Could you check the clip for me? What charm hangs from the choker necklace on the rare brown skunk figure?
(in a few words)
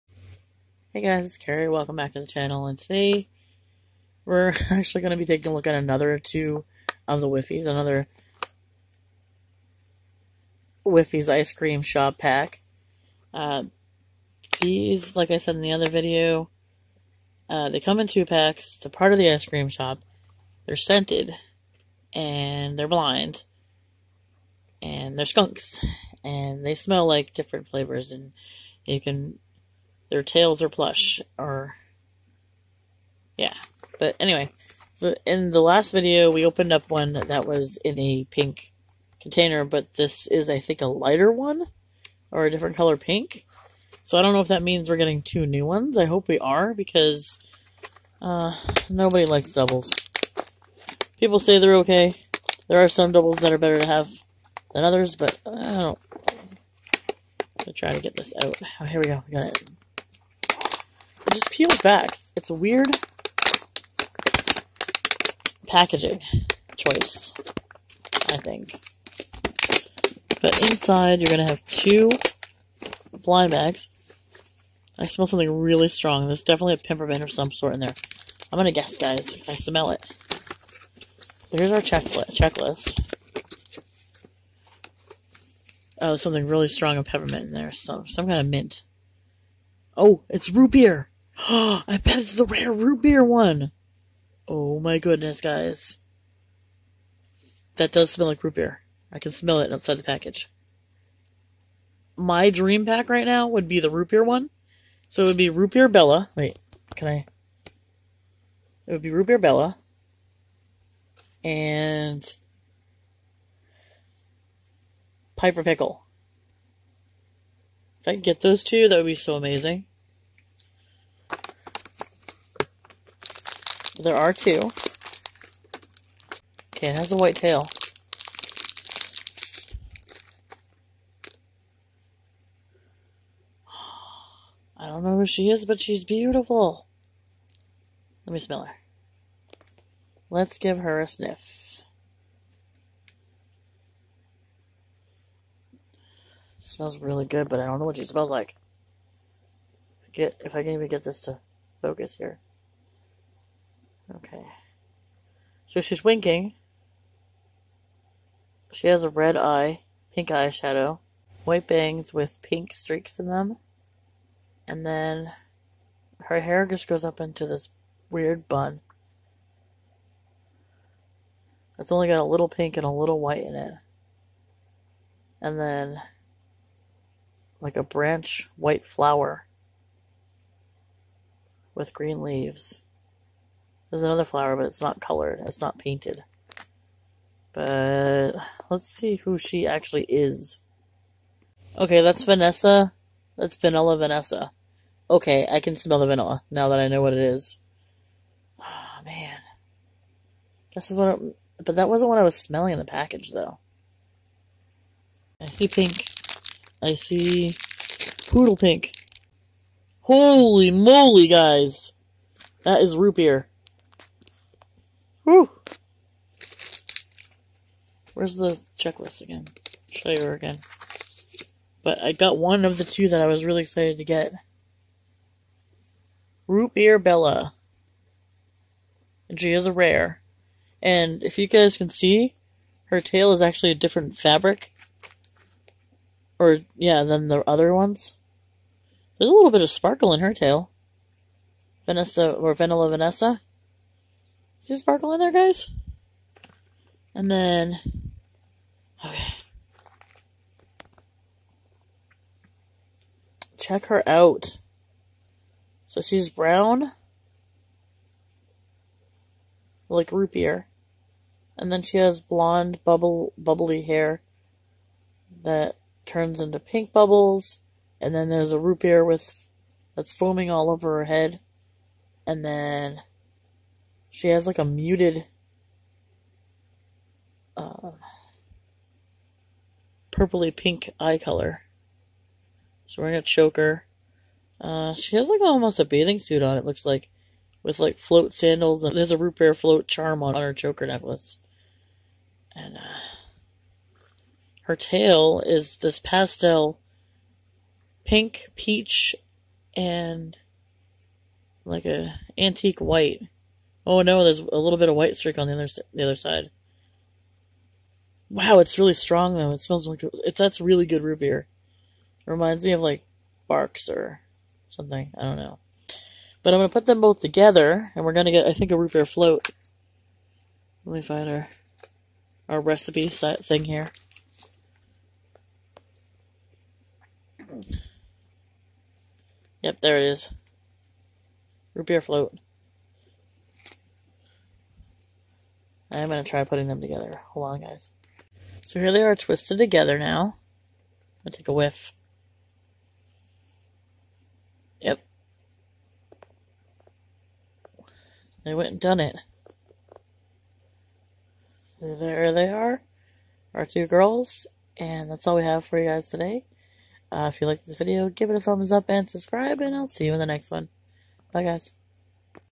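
root beer float charm.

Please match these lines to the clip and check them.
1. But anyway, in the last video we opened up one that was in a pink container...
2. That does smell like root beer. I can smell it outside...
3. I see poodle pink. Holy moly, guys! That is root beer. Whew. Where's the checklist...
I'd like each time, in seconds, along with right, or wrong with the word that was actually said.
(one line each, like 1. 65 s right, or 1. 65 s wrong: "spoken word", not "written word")
1. 33 s right
2. 97 s right
3. 206 s right.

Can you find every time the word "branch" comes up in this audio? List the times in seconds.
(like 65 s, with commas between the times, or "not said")
177 s.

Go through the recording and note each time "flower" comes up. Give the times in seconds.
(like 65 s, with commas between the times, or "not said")
178 s, 184 s.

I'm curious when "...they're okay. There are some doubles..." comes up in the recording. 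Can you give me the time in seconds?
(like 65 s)
51 s.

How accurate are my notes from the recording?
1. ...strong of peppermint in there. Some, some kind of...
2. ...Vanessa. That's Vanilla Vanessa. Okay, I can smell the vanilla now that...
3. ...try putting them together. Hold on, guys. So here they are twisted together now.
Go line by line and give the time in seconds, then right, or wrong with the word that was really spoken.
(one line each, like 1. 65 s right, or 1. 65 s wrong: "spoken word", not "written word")
1. 86 s right
2. 192 s right
3. 336 s right.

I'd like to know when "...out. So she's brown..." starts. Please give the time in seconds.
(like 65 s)
254 s.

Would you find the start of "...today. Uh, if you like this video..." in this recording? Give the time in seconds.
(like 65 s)
356 s.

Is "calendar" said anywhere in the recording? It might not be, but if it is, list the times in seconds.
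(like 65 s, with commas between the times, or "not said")
not said.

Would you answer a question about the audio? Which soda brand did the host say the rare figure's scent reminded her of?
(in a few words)
Barq's.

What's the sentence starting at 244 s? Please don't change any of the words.
Is there sparkle in there, guys?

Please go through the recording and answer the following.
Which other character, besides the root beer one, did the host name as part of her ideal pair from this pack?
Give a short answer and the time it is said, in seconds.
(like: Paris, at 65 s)
Piper Pickle, at 115 s.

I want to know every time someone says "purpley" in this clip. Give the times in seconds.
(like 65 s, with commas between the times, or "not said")
280 s.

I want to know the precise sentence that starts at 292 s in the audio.
And uh, her tail is this pastel pink, peach, and like a antique white.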